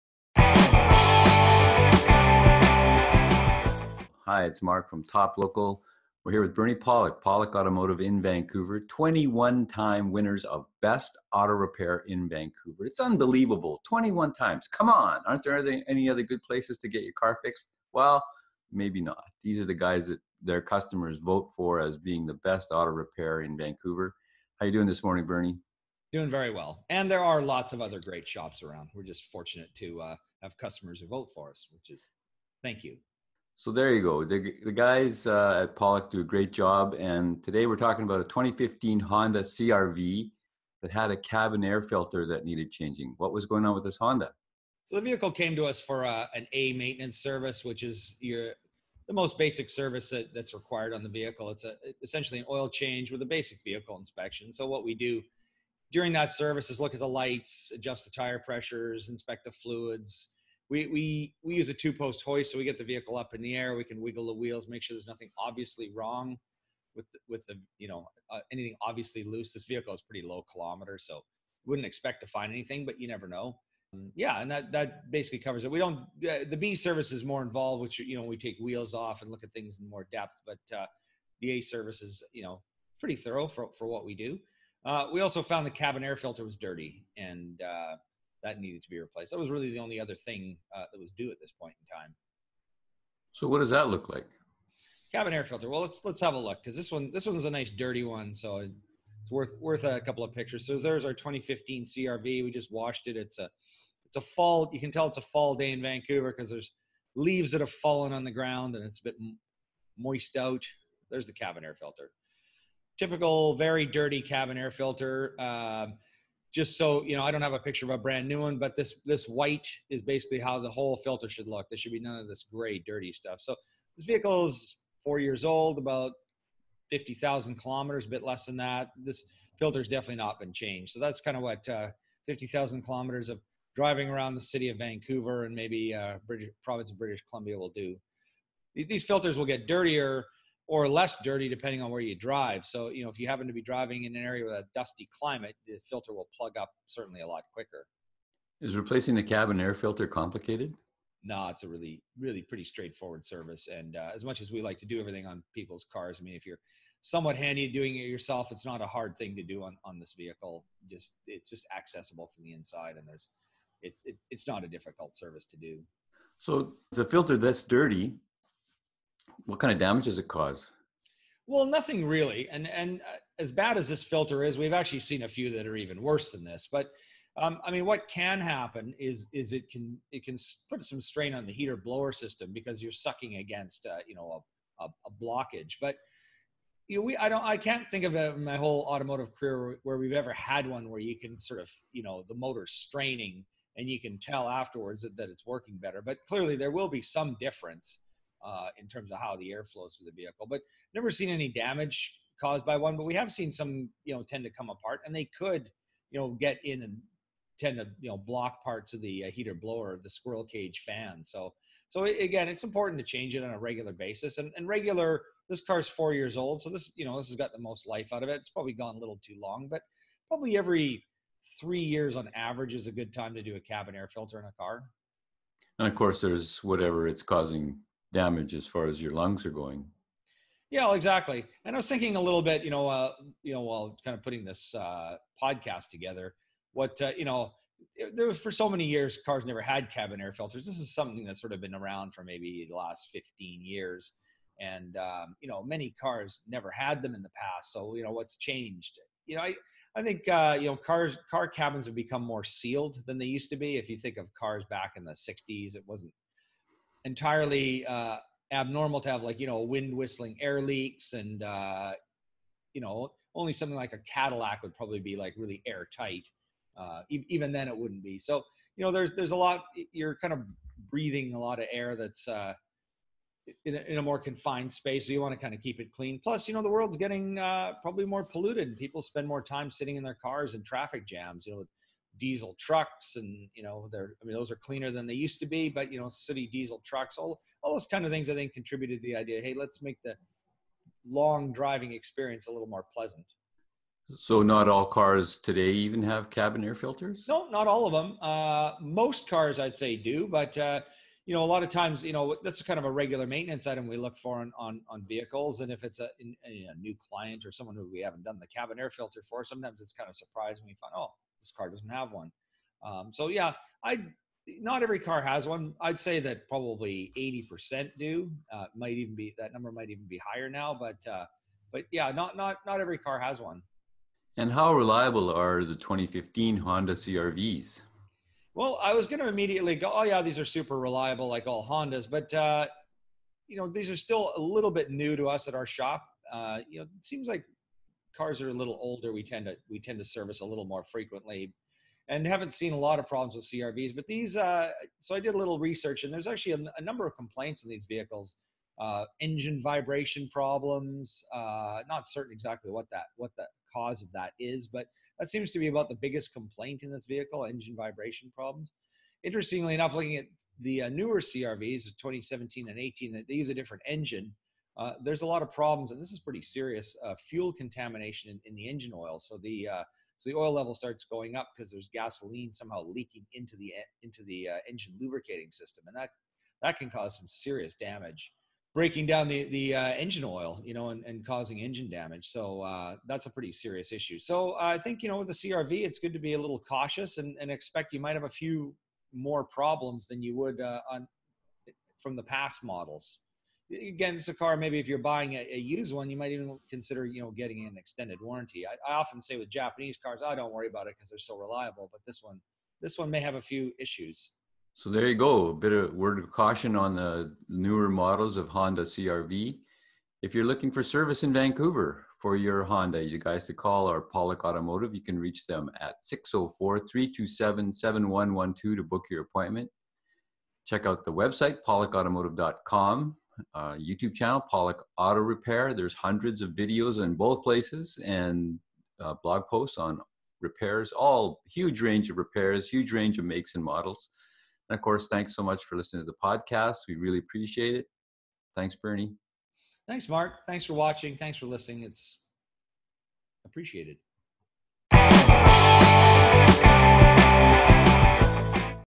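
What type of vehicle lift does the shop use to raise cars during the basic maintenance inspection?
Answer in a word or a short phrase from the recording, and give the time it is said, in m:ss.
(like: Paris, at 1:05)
two post hoist, at 1:01.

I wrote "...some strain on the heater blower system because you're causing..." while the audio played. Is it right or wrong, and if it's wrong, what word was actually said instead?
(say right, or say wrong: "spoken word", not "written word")
wrong: "sucking", not "causing".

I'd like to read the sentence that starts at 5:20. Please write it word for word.
But uh, but yeah, not not not every car has one.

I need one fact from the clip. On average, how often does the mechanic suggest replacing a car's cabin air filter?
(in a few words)
every 3 years.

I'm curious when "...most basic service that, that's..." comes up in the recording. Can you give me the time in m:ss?
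0:49.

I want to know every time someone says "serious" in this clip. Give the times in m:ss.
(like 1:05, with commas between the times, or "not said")
6:06, 6:17, 6:23.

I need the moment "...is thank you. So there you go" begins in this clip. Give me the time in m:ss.
0:31.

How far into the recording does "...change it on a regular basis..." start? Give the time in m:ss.
3:33.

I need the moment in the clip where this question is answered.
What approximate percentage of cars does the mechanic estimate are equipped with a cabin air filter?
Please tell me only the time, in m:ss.
5:17.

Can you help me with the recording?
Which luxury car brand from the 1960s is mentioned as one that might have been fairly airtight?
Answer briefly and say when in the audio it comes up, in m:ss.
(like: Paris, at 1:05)
Cadillac, at 4:23.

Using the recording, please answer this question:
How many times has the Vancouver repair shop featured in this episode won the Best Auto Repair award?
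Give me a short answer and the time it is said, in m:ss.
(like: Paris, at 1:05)
21, at 0:08.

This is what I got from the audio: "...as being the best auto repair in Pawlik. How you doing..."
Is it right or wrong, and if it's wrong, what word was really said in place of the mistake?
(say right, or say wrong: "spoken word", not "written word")
wrong: "Vancouver", not "Pawlik".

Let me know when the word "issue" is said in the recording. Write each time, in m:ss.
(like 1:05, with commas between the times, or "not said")
6:23, 6:43.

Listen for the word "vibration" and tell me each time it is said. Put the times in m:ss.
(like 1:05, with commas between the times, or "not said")
5:49, 5:57.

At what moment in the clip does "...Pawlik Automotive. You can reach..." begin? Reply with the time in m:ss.
6:54.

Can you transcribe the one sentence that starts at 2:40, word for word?
Just it's just accessible from the inside, and there's it's it, it's not a difficult service to do.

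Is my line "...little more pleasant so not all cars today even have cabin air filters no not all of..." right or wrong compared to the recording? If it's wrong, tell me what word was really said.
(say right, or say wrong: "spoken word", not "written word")
right.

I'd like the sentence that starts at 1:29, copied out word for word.
That was really the only other thing uh, that was due at this point in time.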